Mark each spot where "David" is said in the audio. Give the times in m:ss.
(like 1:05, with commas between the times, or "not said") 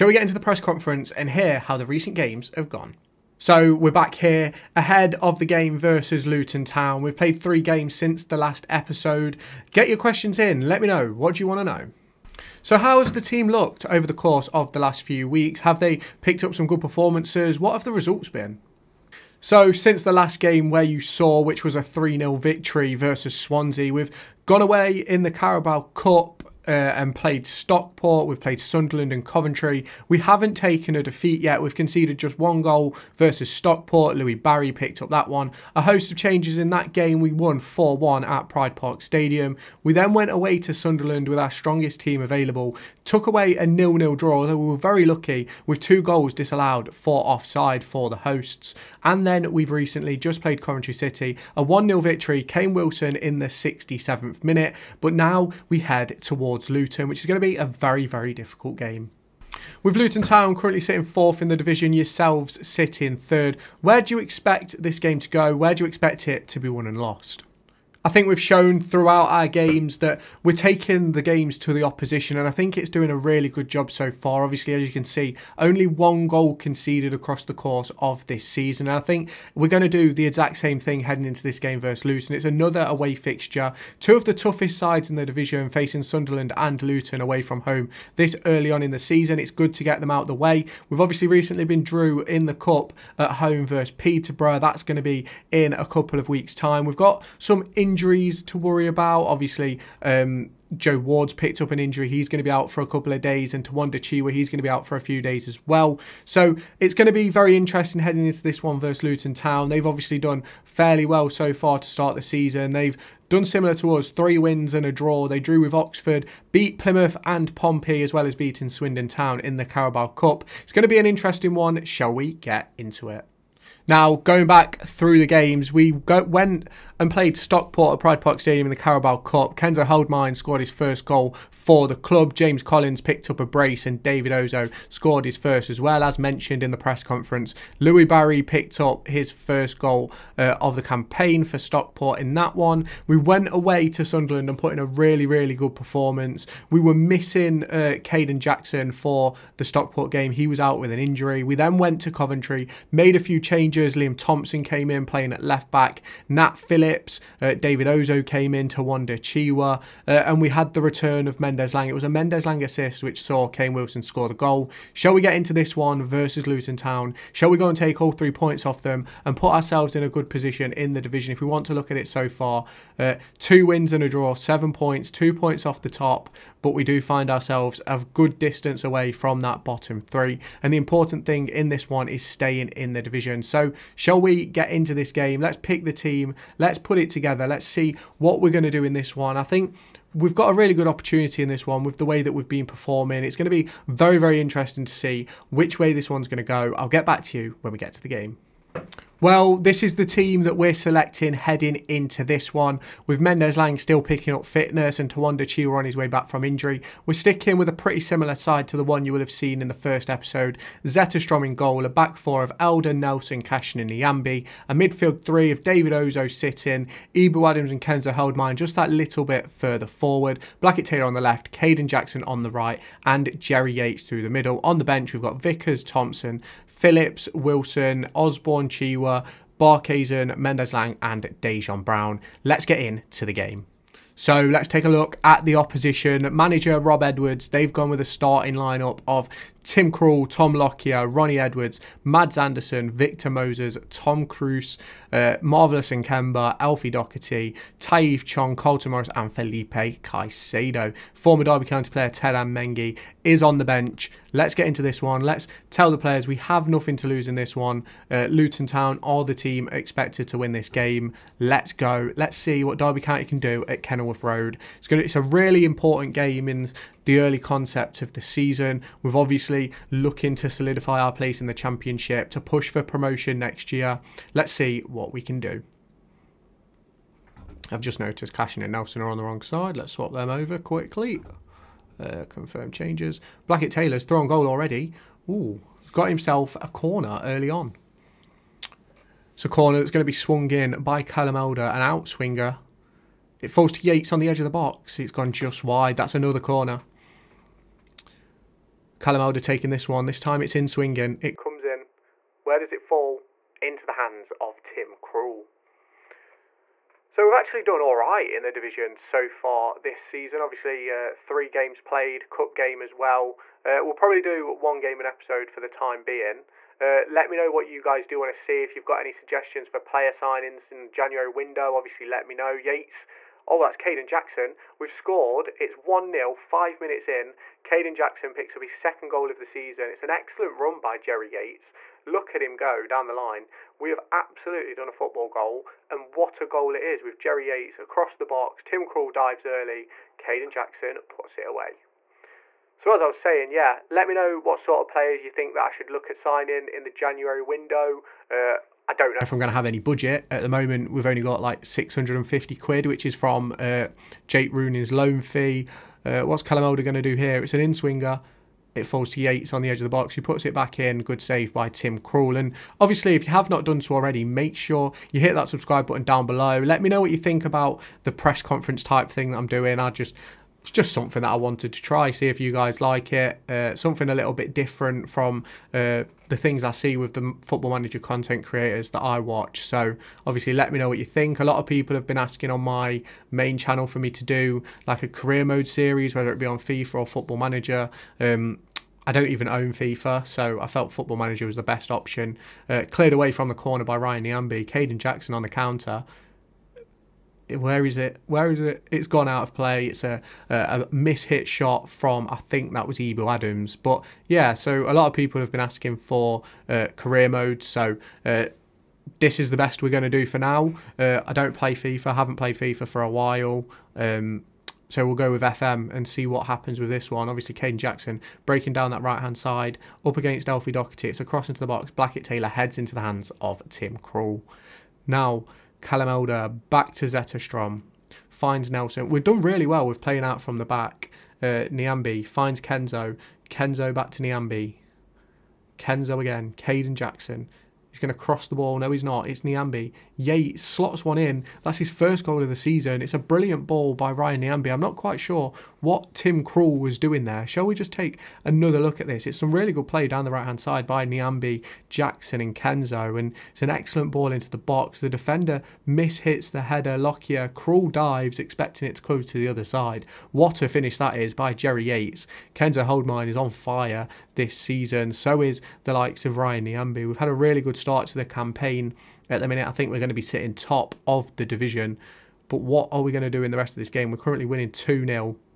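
2:14, 2:37, 3:35.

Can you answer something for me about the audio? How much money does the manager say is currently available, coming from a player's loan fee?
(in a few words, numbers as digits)
650 quid.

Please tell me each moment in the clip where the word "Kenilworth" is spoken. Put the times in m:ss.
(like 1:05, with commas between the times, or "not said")
4:23.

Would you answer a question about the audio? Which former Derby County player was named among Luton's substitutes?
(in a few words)
Teden Mengi.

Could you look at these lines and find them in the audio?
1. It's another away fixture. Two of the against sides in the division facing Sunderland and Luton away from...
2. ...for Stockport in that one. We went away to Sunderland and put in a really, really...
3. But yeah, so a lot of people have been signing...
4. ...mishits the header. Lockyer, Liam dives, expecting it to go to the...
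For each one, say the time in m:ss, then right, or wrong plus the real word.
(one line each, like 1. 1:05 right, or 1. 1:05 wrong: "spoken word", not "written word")
1. 1:22 wrong: "toughest", not "against"
2. 2:21 right
3. 6:43 wrong: "asking", not "signing"
4. 7:35 wrong: "Krul", not "Liam".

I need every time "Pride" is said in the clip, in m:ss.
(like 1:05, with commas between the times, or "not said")
0:38, 2:08.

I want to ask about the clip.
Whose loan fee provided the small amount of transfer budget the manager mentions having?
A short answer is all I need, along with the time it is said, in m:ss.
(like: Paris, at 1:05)
Jake Rooney, at 5:54.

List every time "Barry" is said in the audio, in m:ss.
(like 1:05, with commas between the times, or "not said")
0:34, 2:18.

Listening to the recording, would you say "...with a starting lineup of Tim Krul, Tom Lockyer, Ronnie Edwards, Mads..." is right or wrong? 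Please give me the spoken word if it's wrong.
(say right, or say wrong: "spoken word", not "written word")
right.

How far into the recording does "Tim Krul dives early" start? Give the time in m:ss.
5:38.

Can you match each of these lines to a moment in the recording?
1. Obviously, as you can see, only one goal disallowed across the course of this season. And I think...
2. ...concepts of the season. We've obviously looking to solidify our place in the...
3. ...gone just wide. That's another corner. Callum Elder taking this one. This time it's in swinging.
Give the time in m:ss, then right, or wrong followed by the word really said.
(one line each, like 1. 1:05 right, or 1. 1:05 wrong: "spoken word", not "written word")
1. 1:14 wrong: "conceded", not "disallowed"
2. 4:27 right
3. 4:55 right.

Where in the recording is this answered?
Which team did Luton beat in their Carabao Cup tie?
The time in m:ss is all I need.
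1:58.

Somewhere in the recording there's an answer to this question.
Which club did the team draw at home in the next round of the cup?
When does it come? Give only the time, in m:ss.
1:33.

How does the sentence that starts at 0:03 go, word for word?
So we're back here ahead of the game versus Luton Town.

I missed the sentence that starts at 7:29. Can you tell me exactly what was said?
It's some really good play down the right-hand side by Nyambe, Jackson and Kenzo.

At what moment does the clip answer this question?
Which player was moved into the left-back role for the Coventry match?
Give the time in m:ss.
2:33.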